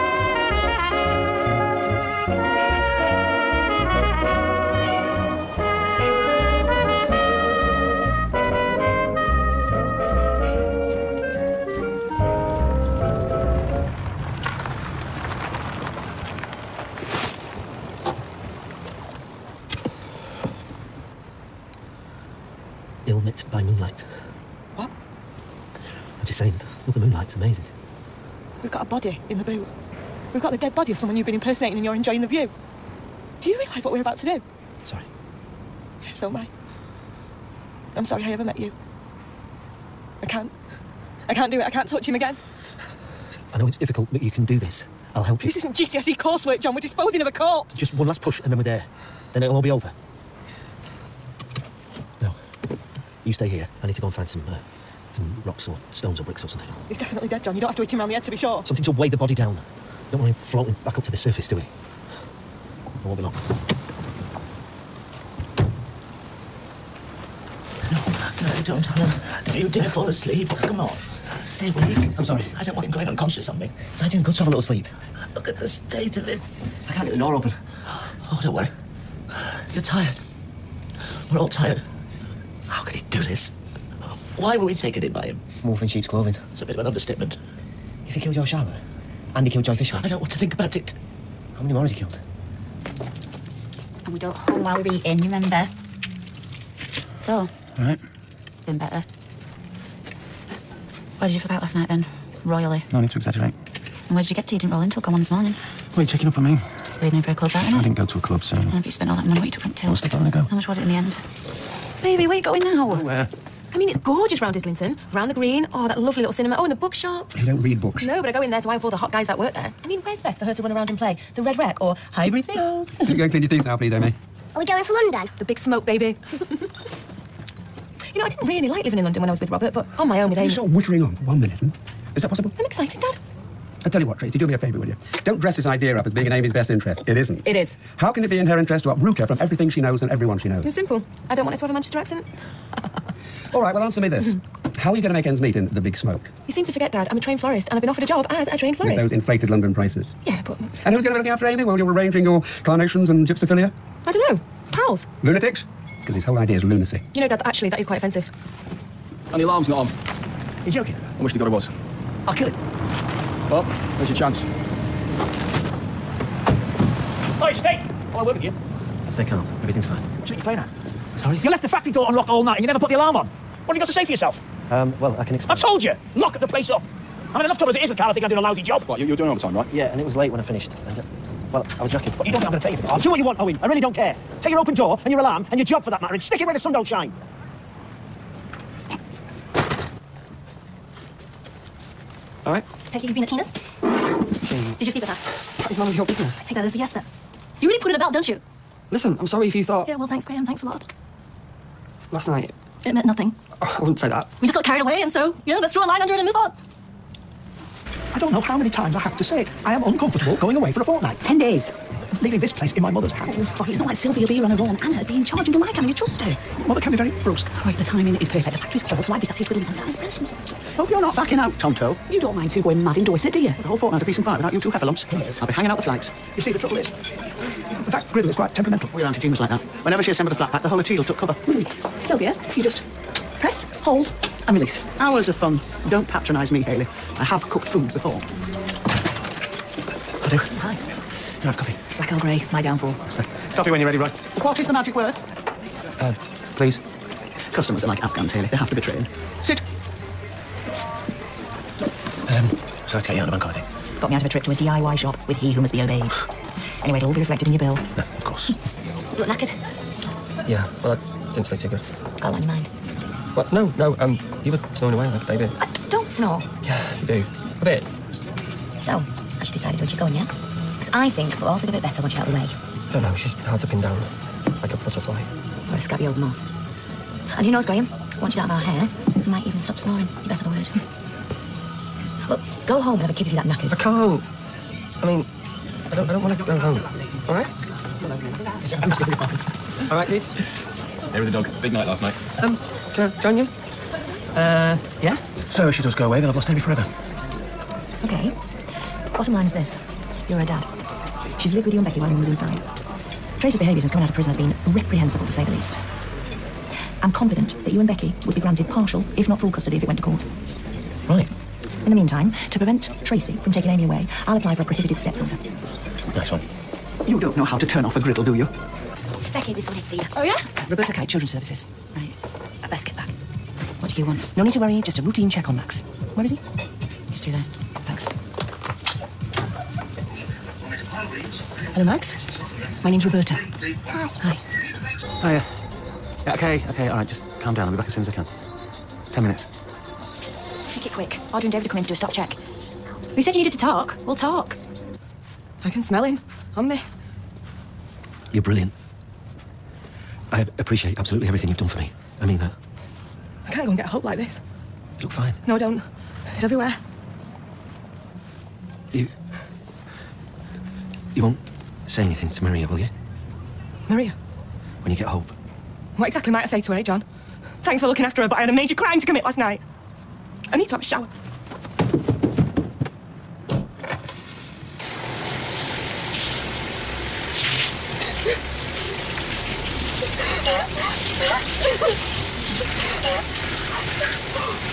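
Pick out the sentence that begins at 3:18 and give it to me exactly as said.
Listen, I'm sorry if you thought...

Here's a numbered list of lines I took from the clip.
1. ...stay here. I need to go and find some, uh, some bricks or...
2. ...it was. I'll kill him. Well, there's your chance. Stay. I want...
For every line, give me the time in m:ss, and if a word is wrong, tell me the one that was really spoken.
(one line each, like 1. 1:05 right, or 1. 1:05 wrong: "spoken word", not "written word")
1. 0:53 wrong: "rocks", not "bricks"
2. 2:41 right.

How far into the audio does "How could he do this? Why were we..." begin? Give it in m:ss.
1:22.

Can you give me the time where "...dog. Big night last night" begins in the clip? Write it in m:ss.
4:51.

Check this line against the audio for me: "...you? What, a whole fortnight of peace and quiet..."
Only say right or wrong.
right.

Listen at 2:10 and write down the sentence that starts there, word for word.
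You stop whittering on for one minute.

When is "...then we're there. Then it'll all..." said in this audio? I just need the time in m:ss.
0:48.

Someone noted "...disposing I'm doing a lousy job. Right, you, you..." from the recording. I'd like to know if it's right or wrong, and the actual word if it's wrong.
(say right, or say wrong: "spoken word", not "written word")
wrong: "thinking", not "disposing".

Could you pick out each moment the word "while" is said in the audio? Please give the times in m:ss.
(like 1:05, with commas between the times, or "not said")
1:34, 2:31, 5:01.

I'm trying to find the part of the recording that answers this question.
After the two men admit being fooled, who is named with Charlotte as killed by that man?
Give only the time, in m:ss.
1:29.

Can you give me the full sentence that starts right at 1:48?
but you spent all that money what you took from Till.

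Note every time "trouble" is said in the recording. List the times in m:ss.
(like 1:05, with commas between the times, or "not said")
2:57, 3:46.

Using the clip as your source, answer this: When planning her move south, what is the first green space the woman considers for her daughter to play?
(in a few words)
The Red Wreck.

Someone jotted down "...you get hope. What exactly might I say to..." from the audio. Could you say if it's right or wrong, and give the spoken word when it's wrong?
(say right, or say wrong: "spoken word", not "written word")
right.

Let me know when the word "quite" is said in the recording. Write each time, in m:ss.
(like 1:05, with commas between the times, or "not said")
2:37, 3:48.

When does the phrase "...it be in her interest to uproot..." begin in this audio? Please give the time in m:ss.
2:18.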